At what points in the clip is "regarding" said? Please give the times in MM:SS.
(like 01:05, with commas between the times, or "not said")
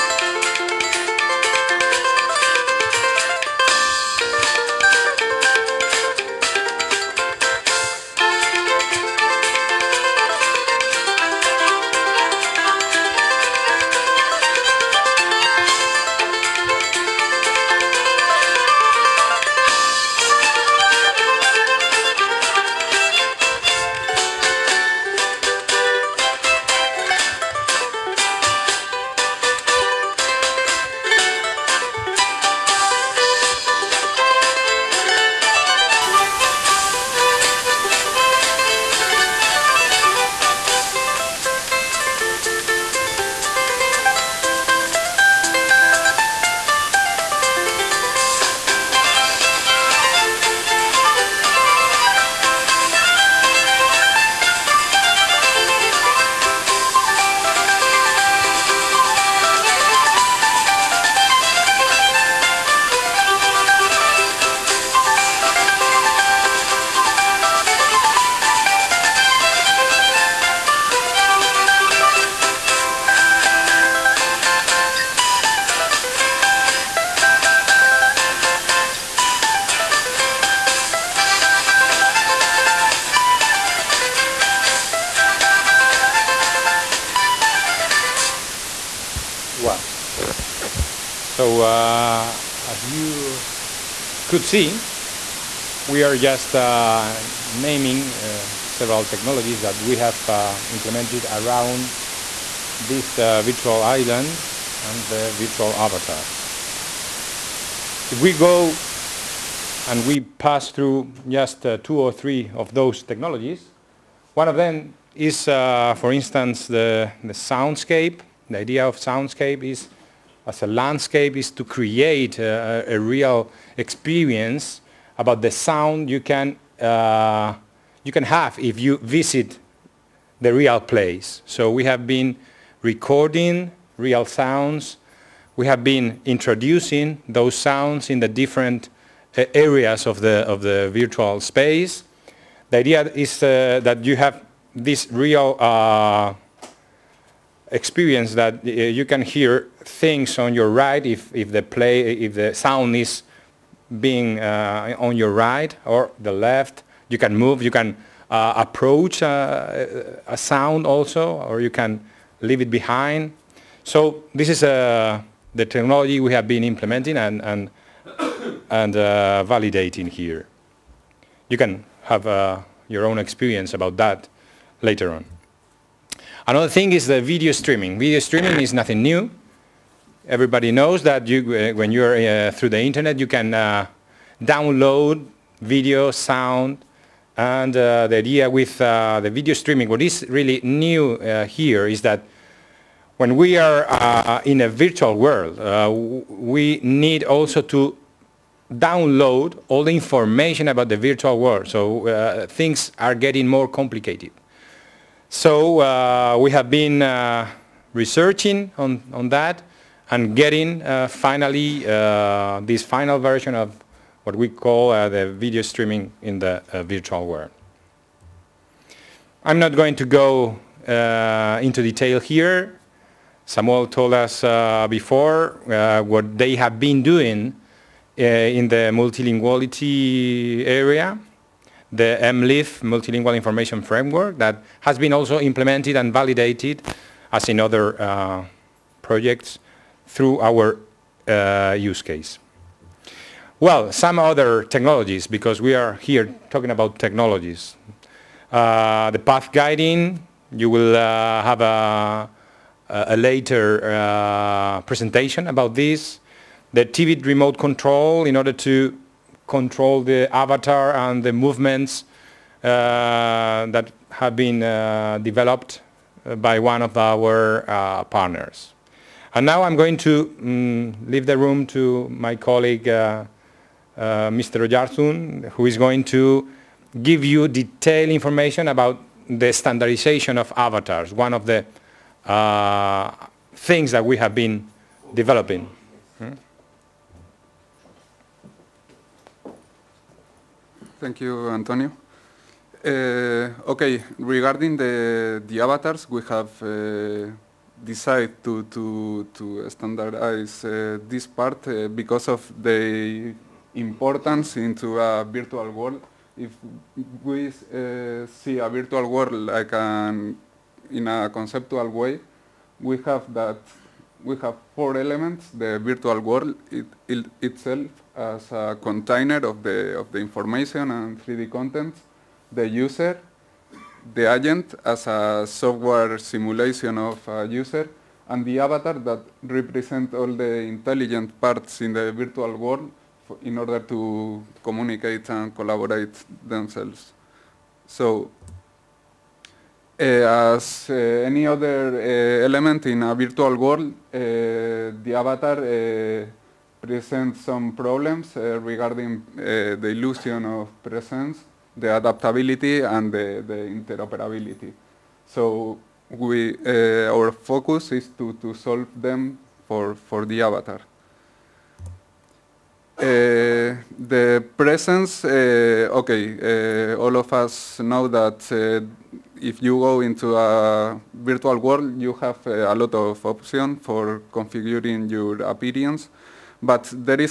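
04:54, 05:48.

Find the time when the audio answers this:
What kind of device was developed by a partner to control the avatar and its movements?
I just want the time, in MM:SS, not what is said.
04:16.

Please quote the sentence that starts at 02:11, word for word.
So we have been recording real sounds.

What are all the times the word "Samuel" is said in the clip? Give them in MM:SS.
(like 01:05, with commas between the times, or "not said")
03:43.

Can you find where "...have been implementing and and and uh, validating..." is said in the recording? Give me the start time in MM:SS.
02:46.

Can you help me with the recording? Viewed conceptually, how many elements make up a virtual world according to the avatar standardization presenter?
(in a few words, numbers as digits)
4.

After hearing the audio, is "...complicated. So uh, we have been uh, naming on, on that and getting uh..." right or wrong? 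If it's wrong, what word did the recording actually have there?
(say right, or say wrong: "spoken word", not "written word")
wrong: "researching", not "naming".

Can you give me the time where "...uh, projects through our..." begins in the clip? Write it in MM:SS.
03:58.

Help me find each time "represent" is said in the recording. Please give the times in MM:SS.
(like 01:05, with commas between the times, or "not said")
05:29.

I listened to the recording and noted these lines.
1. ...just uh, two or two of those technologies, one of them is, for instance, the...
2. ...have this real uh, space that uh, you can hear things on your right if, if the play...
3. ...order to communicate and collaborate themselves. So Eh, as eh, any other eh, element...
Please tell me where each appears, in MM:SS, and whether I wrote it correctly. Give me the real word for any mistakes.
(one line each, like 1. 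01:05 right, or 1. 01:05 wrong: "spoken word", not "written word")
1. 01:51 wrong: "three", not "two"
2. 02:24 wrong: "experience", not "space"
3. 05:33 right.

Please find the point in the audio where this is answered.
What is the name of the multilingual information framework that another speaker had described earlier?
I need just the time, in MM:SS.
03:52.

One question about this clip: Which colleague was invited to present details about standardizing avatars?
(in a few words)
Mr. Oyarzun.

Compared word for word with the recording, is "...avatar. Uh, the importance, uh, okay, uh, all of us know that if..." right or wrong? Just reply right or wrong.
wrong.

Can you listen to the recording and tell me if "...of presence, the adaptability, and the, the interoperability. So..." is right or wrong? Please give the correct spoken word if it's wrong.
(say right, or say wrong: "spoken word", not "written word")
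right.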